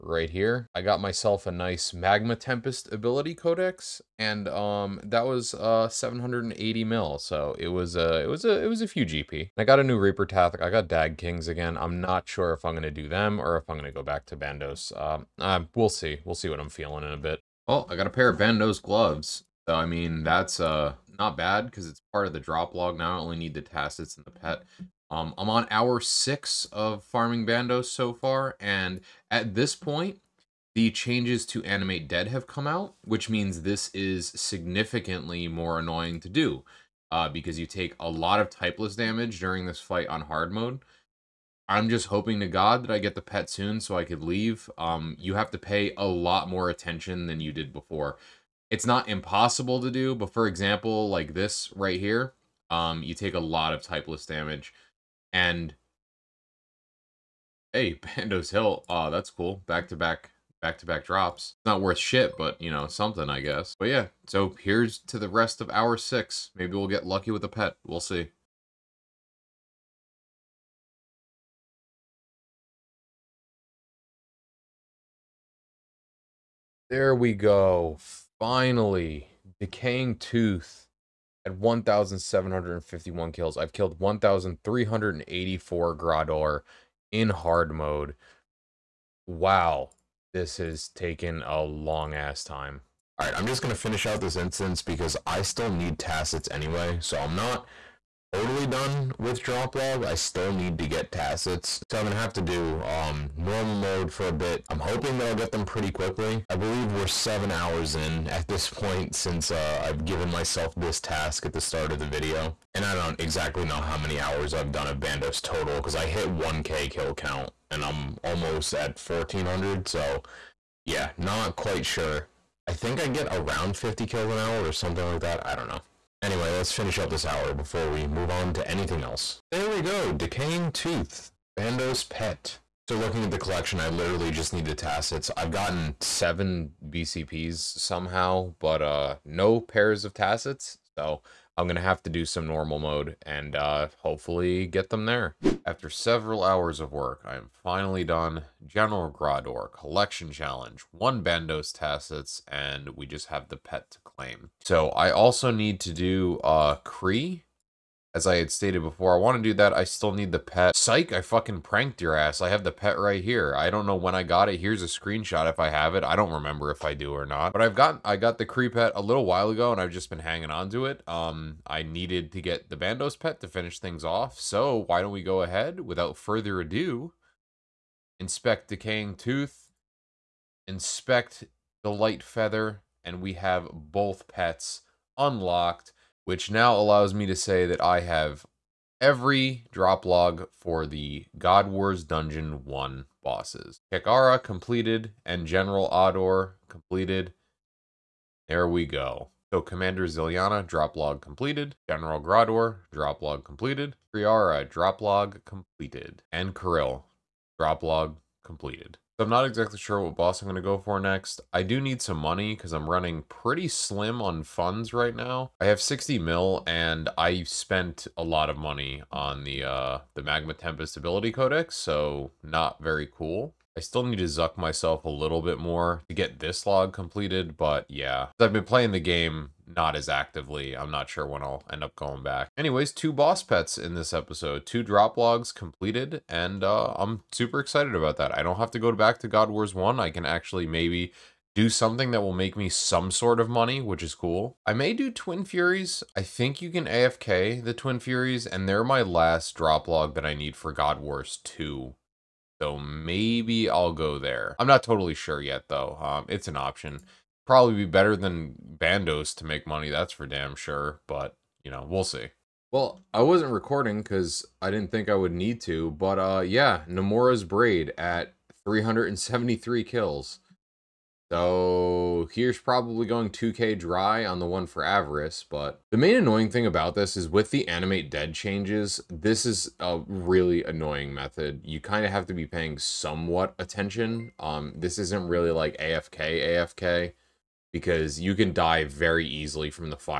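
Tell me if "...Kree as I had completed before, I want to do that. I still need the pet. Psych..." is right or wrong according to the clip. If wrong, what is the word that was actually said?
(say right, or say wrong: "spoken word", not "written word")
wrong: "stated", not "completed".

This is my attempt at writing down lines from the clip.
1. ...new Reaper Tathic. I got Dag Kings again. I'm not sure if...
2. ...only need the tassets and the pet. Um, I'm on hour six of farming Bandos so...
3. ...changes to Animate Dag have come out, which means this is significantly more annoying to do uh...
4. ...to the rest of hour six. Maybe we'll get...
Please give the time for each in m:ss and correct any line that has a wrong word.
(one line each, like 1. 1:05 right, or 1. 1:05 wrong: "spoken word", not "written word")
1. 0:09 right
2. 0:23 right
3. 0:30 wrong: "Dead", not "Dag"
4. 1:05 right.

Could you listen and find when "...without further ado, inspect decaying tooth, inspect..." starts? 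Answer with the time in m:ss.
2:55.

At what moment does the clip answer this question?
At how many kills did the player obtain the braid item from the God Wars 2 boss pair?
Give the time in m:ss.
4:28.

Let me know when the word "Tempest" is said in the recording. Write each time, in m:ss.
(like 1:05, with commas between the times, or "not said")
0:02, 3:40.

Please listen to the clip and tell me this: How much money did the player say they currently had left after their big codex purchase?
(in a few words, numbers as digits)
60 mil.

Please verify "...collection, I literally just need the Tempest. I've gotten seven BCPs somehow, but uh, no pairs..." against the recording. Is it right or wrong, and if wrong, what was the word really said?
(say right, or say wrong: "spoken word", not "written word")
wrong: "Tassets", not "Tempest".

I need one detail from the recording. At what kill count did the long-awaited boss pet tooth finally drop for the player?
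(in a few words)
1,751.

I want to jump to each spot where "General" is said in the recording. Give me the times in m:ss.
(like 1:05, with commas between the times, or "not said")
2:28, 3:15, 3:21.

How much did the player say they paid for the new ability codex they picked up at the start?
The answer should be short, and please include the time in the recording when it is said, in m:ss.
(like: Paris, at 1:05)
780 mil, at 0:05.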